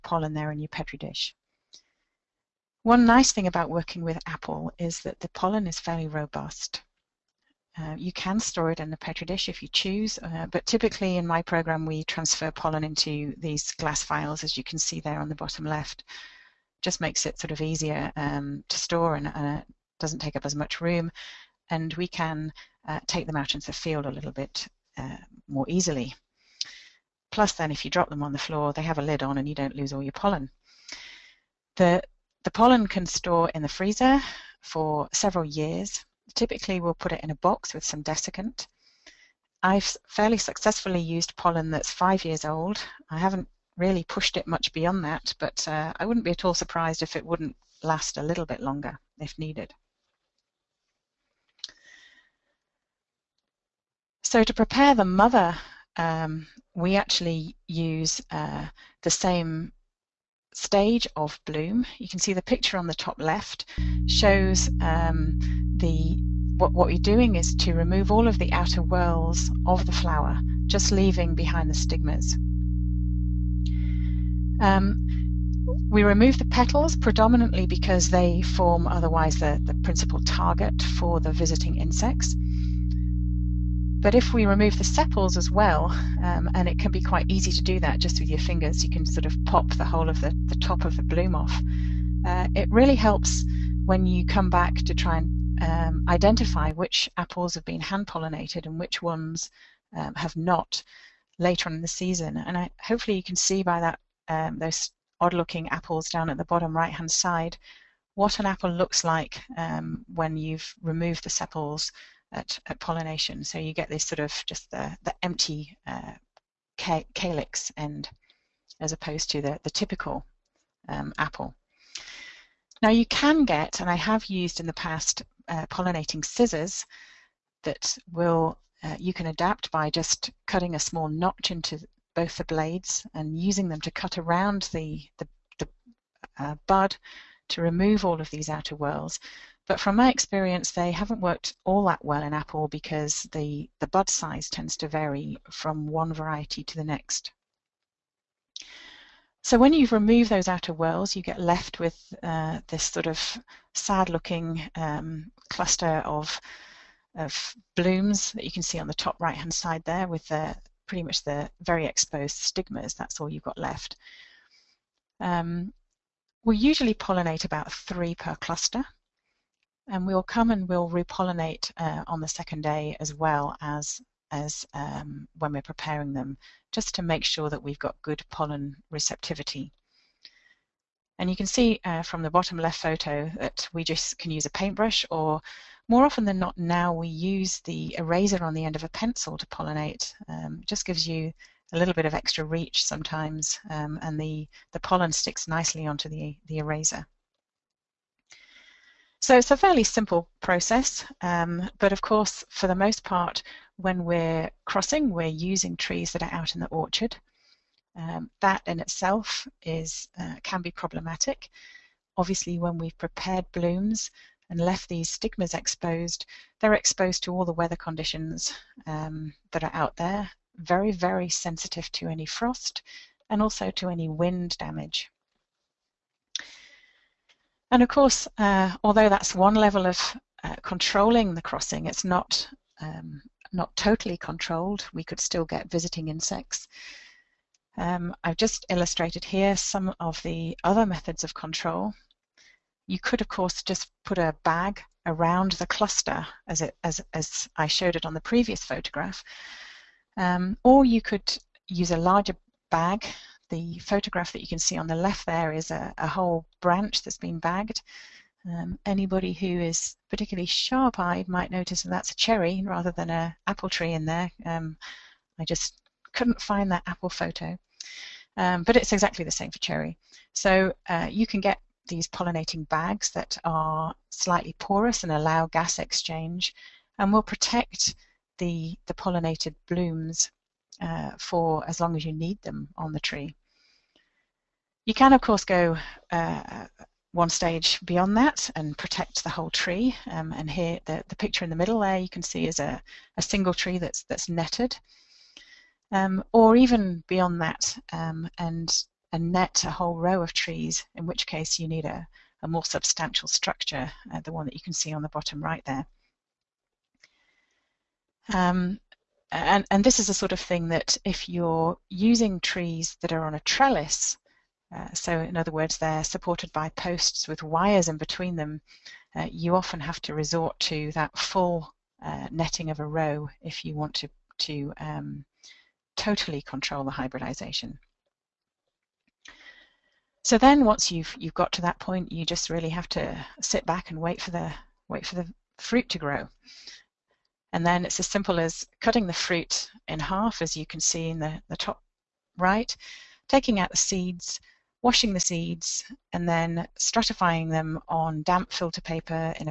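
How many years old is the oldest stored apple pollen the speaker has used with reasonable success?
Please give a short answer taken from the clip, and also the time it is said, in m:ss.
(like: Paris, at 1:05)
5 years, at 0:41.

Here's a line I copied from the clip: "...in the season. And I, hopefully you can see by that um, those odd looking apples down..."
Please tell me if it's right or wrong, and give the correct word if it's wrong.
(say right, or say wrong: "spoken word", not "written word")
right.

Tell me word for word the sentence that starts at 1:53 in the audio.
So you get this sort of just the, the empty uh, calyx end as opposed to the, the typical um, apple.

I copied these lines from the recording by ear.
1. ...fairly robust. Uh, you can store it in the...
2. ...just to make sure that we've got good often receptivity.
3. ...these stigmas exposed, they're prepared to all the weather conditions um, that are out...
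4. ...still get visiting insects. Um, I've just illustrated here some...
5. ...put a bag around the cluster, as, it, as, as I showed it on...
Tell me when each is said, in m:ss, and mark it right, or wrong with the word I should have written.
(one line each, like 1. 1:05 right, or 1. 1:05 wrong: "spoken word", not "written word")
1. 0:05 right
2. 2:56 wrong: "pollen", not "often"
3. 3:34 wrong: "exposed", not "prepared"
4. 3:55 right
5. 4:04 right.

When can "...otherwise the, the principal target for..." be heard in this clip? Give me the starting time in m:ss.
1:18.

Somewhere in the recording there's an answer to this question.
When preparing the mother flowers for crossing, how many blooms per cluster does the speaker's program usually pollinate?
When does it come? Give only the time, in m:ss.
2:47.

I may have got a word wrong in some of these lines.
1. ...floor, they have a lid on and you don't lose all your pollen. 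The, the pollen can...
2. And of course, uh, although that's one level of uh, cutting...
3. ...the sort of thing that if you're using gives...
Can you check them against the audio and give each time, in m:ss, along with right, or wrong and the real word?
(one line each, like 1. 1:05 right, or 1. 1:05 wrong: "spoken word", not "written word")
1. 0:28 right
2. 3:47 wrong: "controlling", not "cutting"
3. 5:10 wrong: "trees", not "gives".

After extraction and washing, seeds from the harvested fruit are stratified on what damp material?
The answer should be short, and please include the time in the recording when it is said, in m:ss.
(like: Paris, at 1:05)
Filter paper, at 5:48.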